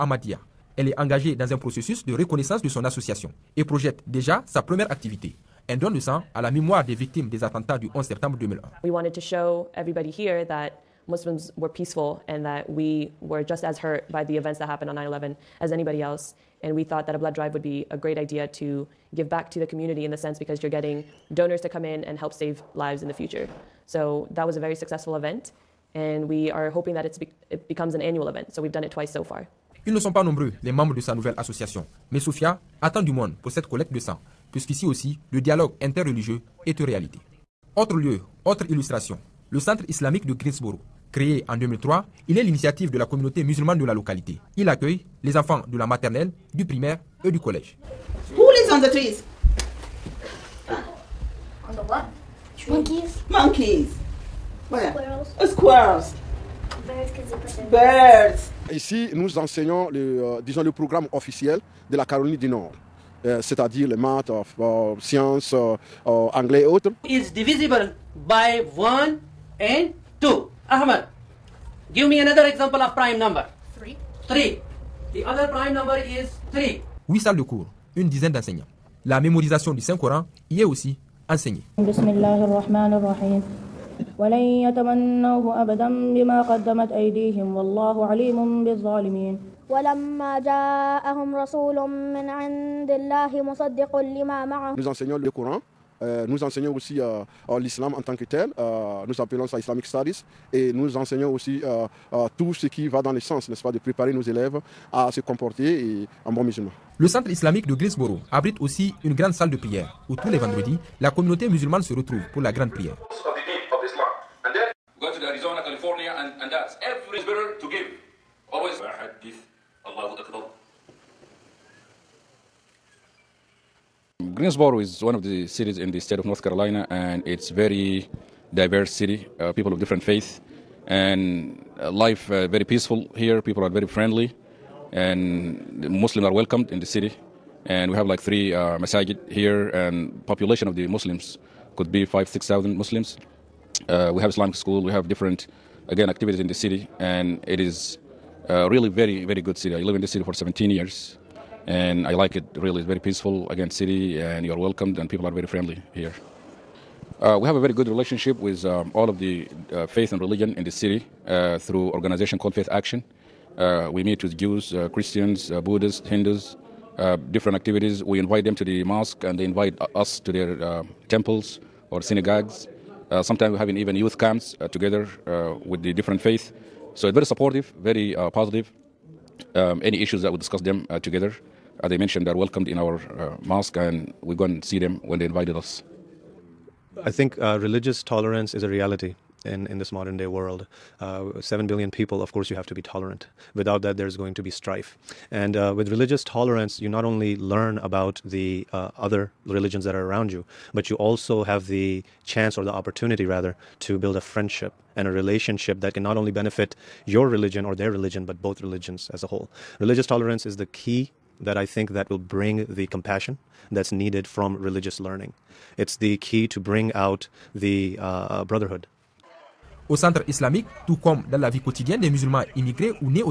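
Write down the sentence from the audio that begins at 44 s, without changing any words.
Il accueille les enfants de la maternelle, du primaire et du collège.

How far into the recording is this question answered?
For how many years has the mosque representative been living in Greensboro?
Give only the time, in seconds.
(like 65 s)
150 s.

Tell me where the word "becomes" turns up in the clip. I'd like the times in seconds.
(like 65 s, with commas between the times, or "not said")
27 s.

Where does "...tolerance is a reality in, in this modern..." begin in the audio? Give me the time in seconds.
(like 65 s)
188 s.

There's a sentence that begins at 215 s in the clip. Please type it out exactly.
It's the key to bring out the uh, uh brotherhood.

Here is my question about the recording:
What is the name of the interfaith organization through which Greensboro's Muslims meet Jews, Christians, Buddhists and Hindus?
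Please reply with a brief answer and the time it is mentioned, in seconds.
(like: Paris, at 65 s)
Faith Action, at 162 s.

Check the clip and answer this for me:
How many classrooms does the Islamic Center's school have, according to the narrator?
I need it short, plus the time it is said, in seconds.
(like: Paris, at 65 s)
8, at 77 s.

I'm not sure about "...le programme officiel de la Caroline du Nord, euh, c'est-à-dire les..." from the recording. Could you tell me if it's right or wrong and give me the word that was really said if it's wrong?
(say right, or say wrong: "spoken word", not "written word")
right.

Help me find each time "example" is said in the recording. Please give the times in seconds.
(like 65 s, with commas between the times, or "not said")
72 s.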